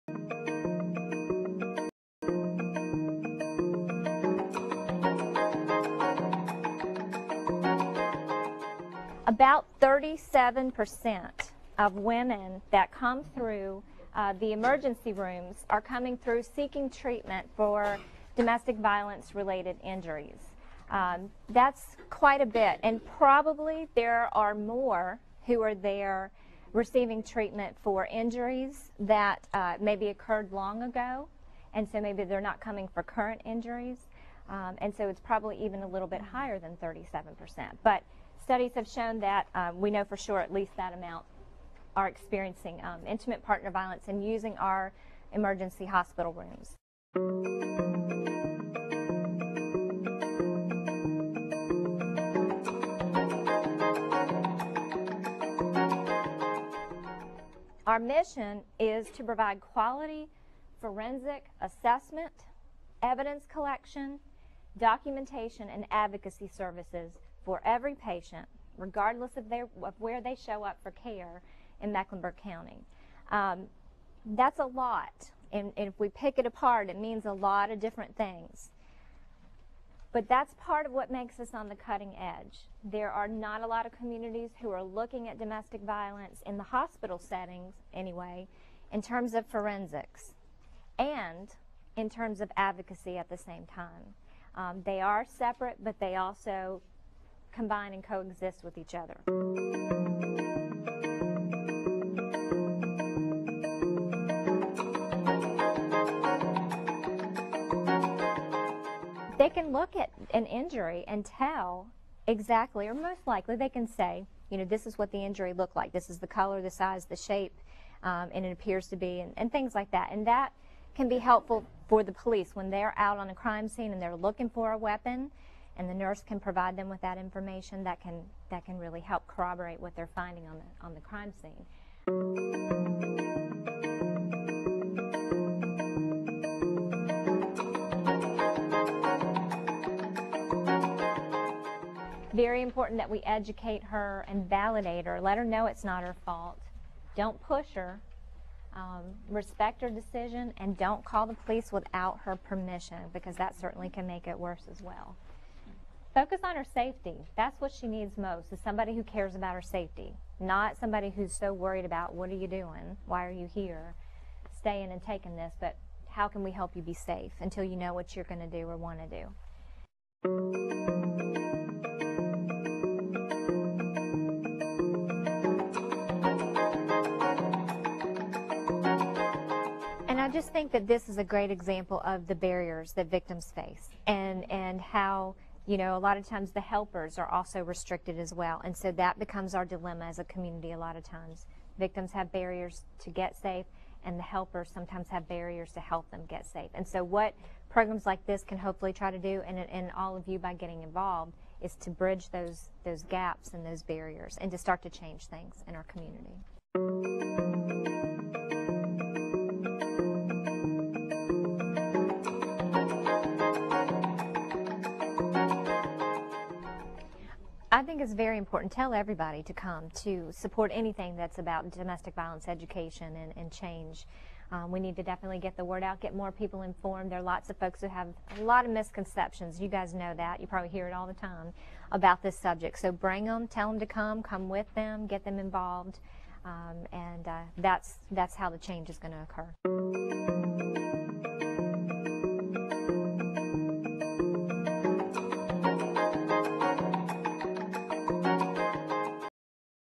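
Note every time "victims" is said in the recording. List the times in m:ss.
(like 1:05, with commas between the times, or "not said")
3:03, 3:11.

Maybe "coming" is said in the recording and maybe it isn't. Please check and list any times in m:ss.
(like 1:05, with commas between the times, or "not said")
0:15, 0:32.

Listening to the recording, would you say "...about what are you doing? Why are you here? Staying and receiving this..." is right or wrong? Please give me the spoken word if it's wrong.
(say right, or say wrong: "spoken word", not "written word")
wrong: "taking", not "receiving".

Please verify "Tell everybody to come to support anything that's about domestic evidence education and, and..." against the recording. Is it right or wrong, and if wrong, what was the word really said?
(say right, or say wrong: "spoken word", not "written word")
wrong: "violence", not "evidence".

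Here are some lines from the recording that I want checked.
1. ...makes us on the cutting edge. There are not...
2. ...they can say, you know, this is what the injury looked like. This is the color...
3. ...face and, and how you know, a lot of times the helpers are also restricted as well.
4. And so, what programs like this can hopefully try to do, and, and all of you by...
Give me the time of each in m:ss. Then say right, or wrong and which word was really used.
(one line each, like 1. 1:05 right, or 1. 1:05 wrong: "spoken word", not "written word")
1. 1:21 right
2. 1:53 right
3. 3:03 right
4. 3:16 right.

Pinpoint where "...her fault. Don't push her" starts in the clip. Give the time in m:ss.
2:26.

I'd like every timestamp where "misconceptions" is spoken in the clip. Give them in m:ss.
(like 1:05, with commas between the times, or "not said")
3:48.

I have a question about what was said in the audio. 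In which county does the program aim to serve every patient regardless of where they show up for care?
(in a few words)
Mecklenburg County.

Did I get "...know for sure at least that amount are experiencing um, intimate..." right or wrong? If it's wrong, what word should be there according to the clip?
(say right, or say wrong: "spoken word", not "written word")
right.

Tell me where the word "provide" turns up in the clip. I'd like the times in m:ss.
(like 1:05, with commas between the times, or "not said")
0:59, 2:06.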